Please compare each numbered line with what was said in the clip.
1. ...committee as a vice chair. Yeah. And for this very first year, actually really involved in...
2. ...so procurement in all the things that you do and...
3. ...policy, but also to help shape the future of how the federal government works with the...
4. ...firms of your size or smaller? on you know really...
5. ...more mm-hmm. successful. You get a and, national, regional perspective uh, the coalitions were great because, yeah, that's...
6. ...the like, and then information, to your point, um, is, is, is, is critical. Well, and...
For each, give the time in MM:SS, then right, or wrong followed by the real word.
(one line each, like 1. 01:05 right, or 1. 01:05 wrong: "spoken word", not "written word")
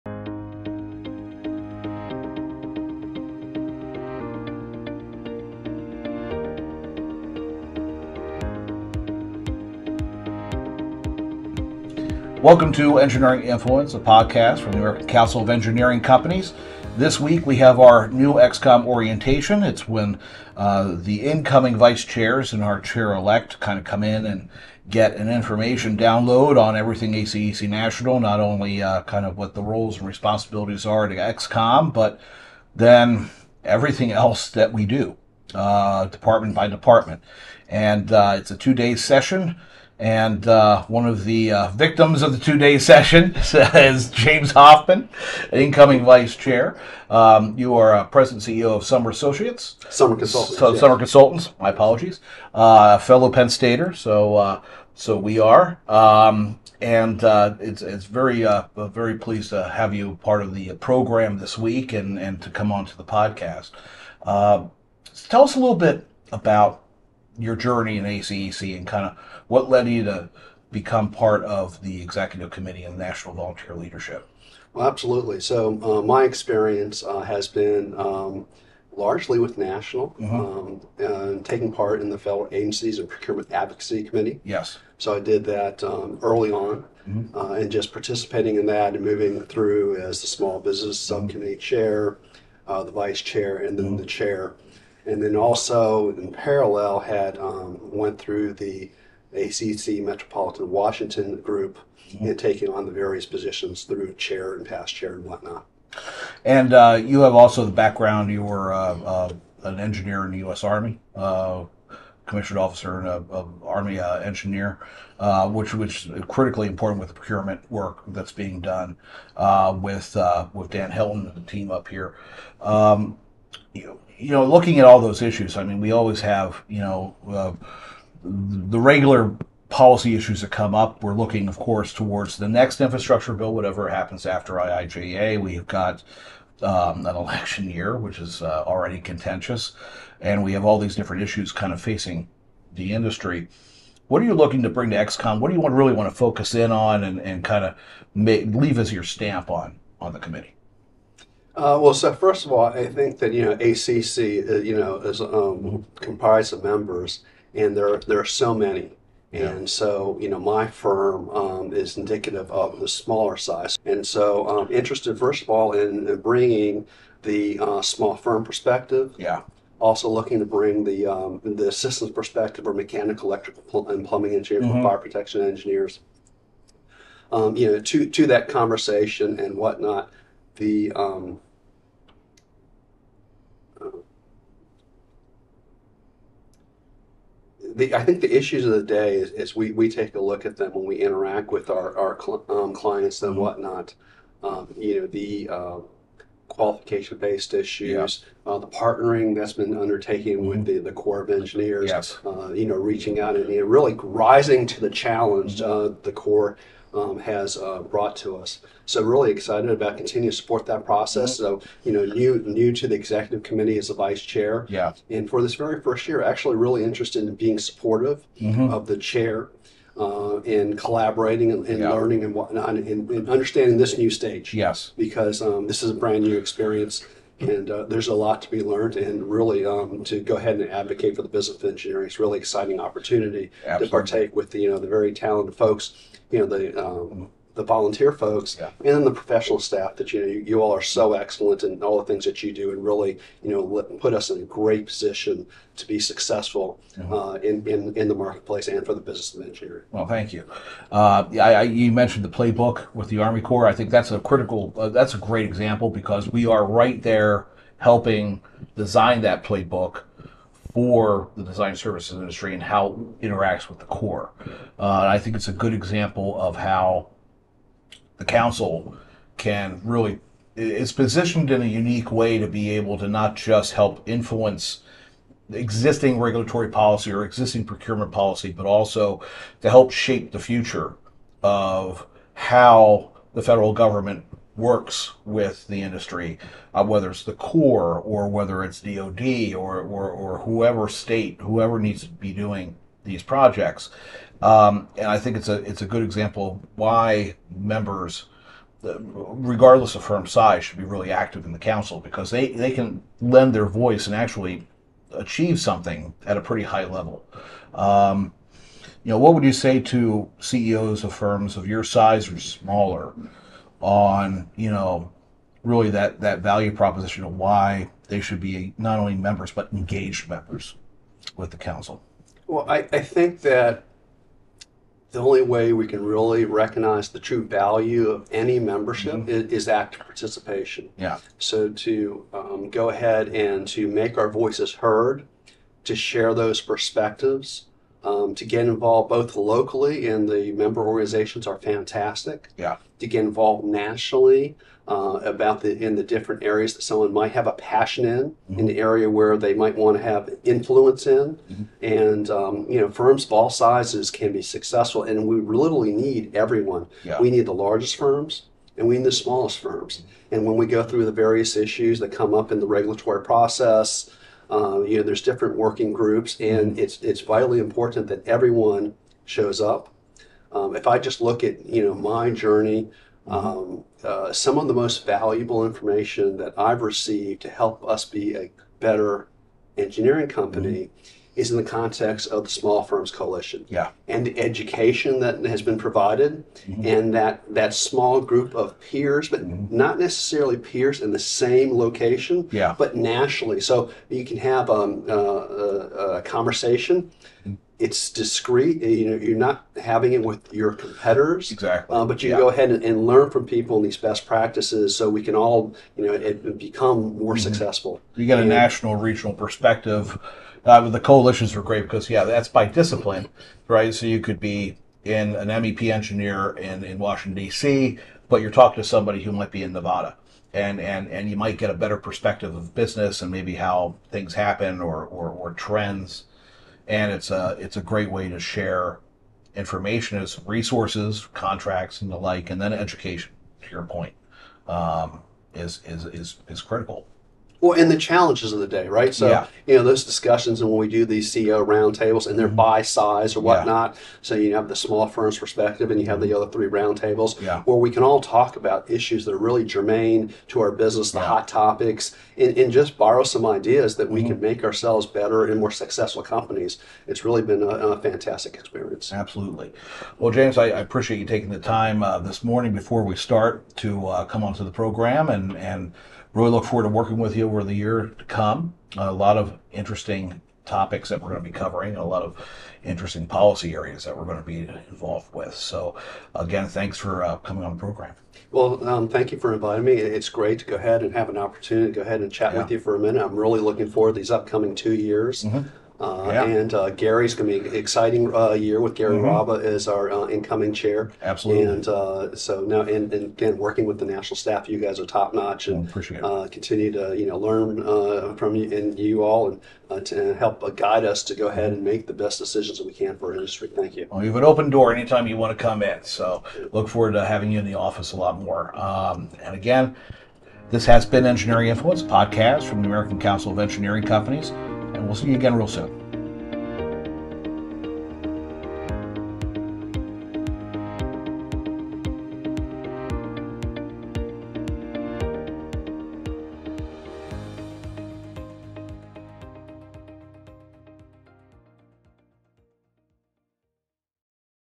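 1. 03:33 wrong: "interested", not "involved"
2. 04:00 wrong: "excellent", not "procurement"
3. 04:38 right
4. 05:11 right
5. 06:47 right
6. 07:12 wrong: "education", not "information".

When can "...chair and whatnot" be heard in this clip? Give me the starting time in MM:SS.
01:44.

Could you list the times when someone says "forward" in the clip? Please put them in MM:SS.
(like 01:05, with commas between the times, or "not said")
07:46, 08:03, 08:26.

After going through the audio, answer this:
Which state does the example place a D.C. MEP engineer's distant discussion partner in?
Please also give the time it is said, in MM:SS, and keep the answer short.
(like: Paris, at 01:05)
Nevada, at 06:59.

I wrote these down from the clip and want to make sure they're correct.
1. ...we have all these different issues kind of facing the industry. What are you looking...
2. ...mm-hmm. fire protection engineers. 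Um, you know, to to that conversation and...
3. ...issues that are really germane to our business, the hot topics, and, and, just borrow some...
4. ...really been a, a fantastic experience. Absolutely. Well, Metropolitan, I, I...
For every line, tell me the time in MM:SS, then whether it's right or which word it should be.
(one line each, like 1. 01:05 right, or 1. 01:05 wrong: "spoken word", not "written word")
1. 02:20 right
2. 02:54 right
3. 07:28 right
4. 07:37 wrong: "James", not "Metropolitan".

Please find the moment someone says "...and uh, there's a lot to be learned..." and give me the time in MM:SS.
03:47.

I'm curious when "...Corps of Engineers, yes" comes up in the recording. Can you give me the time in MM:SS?
03:20.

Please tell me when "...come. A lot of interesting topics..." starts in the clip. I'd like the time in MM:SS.
07:48.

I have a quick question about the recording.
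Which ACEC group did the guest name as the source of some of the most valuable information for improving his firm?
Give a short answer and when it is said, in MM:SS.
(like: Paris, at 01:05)
Small Firms Coalition, at 06:22.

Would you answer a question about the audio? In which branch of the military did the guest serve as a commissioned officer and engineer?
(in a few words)
U.S. Army.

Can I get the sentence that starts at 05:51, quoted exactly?
and um, you know firms of all sizes can be successful, and we literally need everyone.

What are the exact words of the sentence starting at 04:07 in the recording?
uh, in, in in the marketplace and for the business of engineering.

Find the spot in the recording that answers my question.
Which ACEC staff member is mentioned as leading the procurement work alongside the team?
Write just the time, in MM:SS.
02:00.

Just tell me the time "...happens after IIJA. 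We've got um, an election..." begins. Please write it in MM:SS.
02:13.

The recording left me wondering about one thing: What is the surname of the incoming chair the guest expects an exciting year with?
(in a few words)
Raba.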